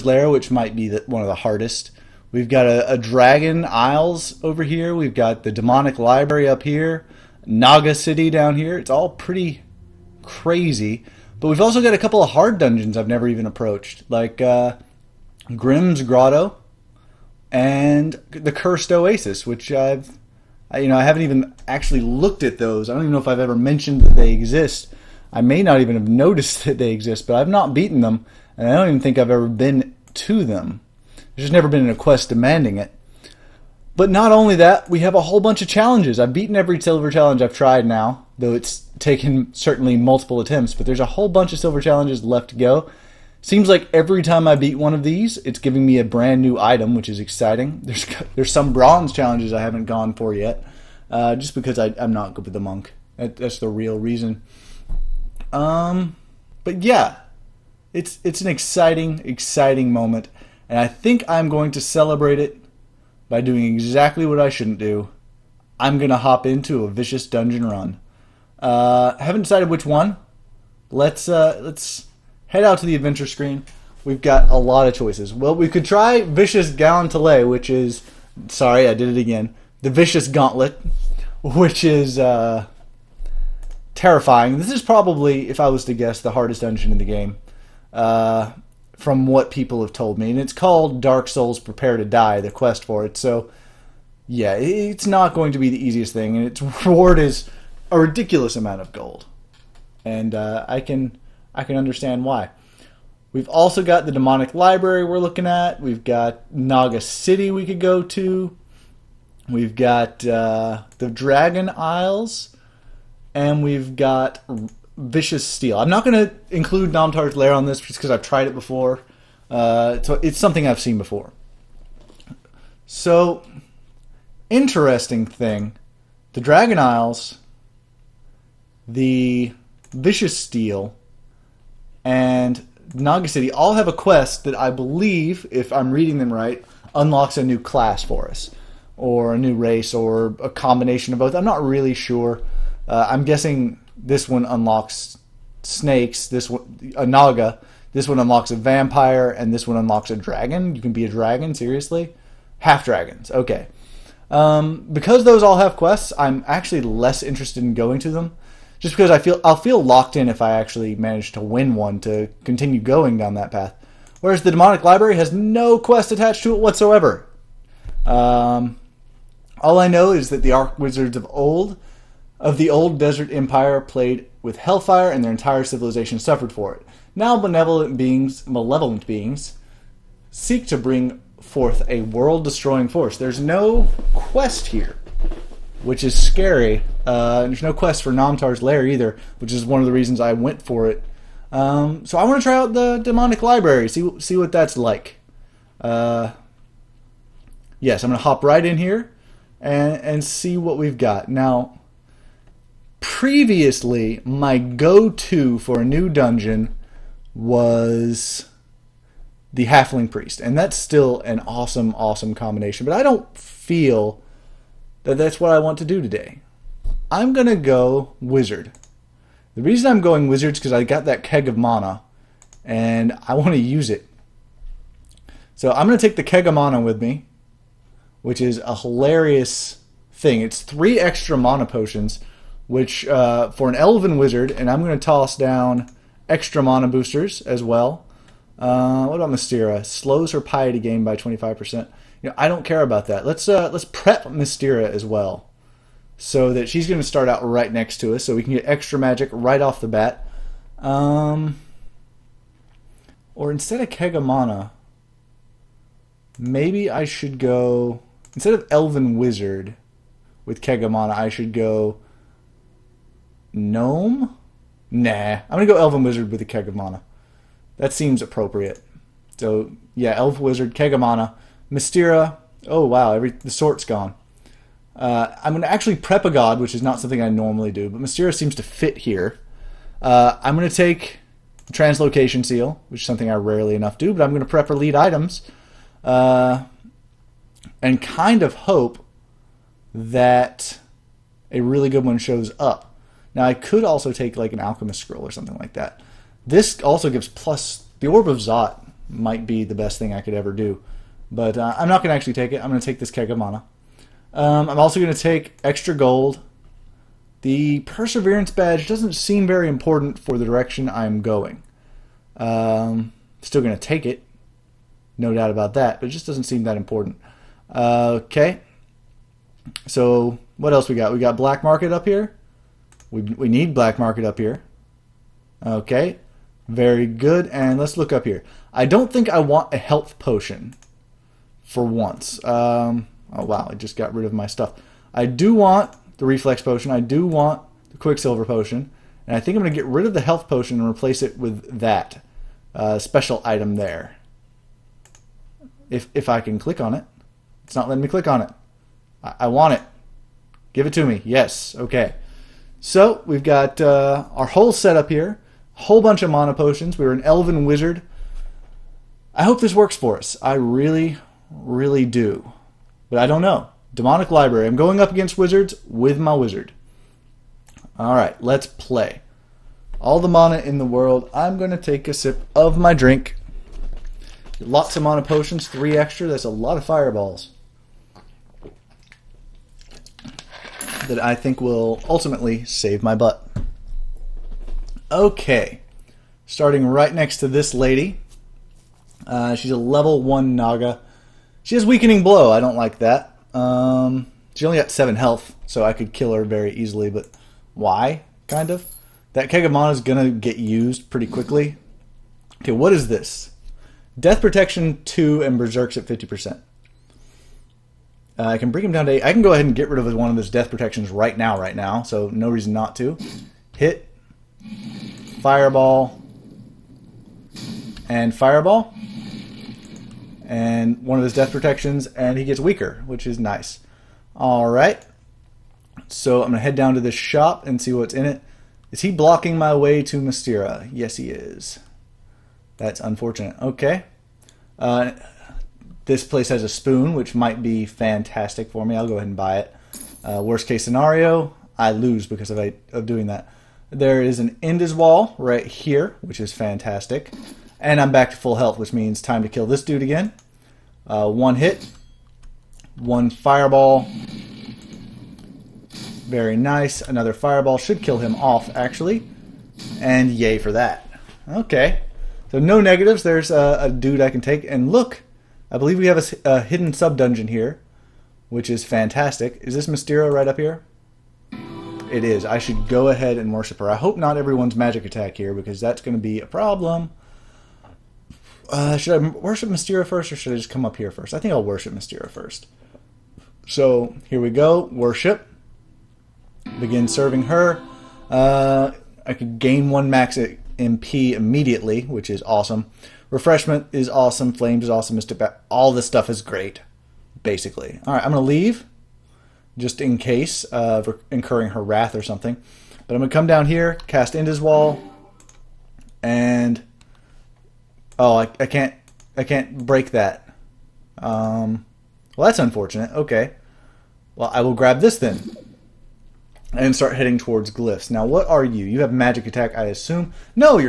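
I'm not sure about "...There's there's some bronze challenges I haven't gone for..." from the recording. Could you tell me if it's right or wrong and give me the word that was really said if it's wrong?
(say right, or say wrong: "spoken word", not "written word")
right.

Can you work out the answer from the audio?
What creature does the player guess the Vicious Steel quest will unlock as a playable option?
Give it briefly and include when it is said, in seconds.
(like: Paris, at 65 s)
vampire, at 148 s.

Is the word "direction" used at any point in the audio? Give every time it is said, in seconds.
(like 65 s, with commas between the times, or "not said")
310 s.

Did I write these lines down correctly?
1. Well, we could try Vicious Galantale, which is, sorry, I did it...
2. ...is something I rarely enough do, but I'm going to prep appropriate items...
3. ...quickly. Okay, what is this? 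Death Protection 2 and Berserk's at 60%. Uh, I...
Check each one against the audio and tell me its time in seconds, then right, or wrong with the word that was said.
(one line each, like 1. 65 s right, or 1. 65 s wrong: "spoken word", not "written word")
1. 75 s right
2. 283 s wrong: "elite", not "appropriate"
3. 401 s wrong: "50", not "60".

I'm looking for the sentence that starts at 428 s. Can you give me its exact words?
Is he blocking my way to Mystera?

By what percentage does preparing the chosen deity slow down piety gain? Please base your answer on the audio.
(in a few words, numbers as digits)
25%.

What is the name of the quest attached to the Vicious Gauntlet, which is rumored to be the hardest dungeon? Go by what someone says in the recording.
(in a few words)
Dark Souls Prepare to Die.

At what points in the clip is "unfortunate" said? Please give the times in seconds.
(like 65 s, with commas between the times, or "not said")
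432 s, 512 s.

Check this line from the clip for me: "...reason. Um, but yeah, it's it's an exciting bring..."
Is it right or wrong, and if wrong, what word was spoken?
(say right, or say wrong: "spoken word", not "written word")
wrong: "exciting", not "bring".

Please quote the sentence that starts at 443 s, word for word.
There is an Endiswal right here, which is fantastic.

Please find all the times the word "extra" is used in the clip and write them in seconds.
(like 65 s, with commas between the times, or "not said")
230 s, 236 s, 248 s, 305 s, 375 s.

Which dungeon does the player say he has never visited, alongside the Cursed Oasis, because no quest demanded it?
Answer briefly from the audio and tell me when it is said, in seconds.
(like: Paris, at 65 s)
Grimm's Grotto, at 15 s.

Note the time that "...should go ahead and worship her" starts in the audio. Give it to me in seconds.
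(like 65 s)
472 s.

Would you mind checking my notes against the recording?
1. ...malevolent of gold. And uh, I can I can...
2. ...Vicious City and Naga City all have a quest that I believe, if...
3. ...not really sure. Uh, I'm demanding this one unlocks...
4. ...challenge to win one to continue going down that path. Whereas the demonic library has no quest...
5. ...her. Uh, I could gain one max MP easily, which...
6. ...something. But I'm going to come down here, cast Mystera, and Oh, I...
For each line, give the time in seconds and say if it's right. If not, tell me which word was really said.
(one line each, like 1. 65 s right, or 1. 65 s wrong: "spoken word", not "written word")
1. 98 s wrong: "amount", not "malevolent"
2. 129 s wrong: "Steel", not "City"
3. 141 s wrong: "guessing", not "demanding"
4. 160 s wrong: "manage", not "challenge"
5. 487 s wrong: "immediately", not "easily"
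6. 502 s wrong: "Endiswal", not "Mystera".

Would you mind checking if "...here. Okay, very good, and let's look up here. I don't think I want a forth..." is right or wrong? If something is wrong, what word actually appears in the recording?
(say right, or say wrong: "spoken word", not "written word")
wrong: "health", not "forth".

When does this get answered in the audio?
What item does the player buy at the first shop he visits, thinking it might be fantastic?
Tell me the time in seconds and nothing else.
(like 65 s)
436 s.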